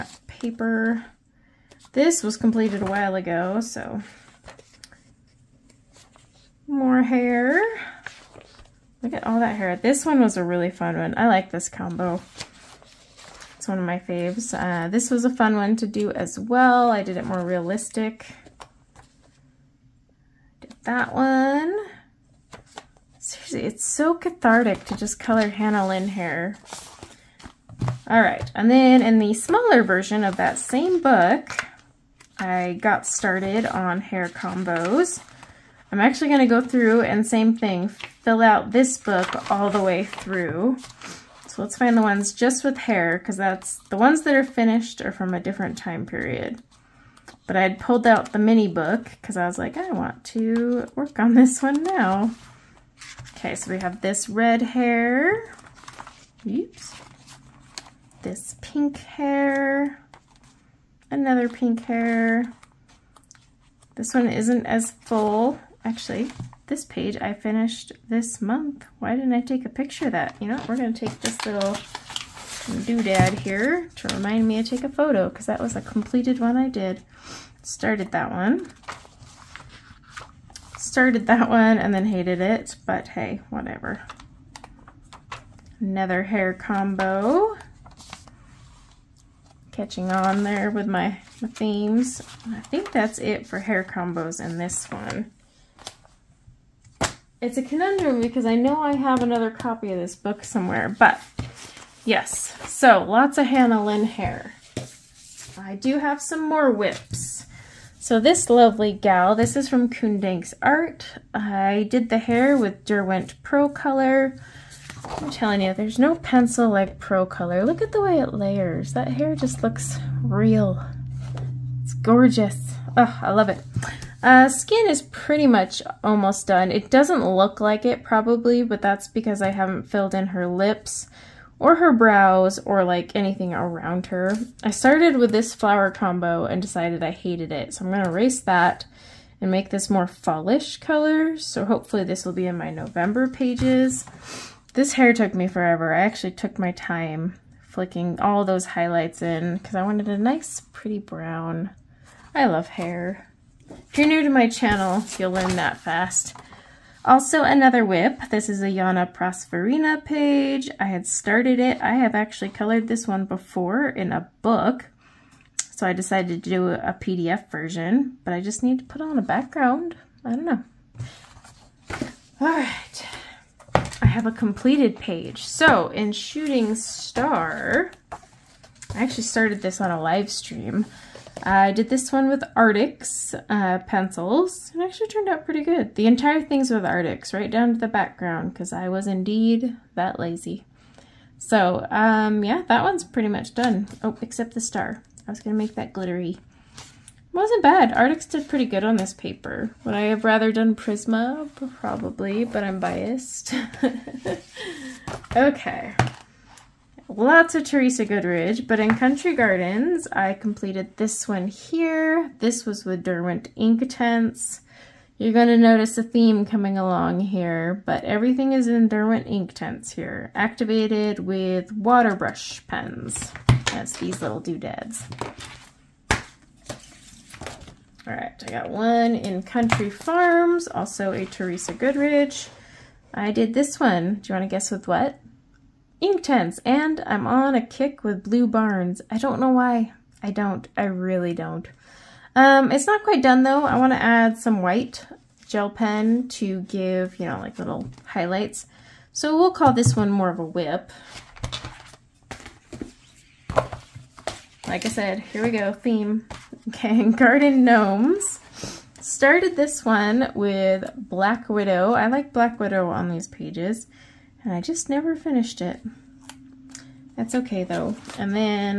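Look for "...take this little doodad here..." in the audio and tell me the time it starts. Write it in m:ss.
1:11.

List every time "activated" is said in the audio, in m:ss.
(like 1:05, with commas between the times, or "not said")
3:40.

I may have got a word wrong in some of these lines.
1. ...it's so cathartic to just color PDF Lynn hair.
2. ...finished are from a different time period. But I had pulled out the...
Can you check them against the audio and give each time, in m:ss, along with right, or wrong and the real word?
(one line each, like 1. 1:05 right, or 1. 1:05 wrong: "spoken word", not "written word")
1. 0:23 wrong: "Hannah", not "PDF"
2. 0:44 right.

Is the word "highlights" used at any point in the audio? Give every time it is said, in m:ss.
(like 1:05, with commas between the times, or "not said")
2:28, 4:08.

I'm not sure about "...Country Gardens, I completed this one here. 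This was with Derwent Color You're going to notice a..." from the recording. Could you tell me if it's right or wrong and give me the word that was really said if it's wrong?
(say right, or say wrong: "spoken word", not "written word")
wrong: "Ink", not "Color".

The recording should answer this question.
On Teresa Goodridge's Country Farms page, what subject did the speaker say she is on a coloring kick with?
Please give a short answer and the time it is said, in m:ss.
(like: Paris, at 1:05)
Blue Barns, at 3:58.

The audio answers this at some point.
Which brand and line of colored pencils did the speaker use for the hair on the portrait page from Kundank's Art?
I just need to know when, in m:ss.
1:52.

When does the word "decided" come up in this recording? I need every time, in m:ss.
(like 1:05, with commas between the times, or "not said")
2:16, 2:45.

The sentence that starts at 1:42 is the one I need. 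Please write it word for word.
So lots of Hannah Lynn hair.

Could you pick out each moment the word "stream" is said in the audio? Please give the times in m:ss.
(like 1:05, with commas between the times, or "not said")
3:00.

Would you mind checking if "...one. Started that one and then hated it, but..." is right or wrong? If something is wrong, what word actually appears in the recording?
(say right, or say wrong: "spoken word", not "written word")
right.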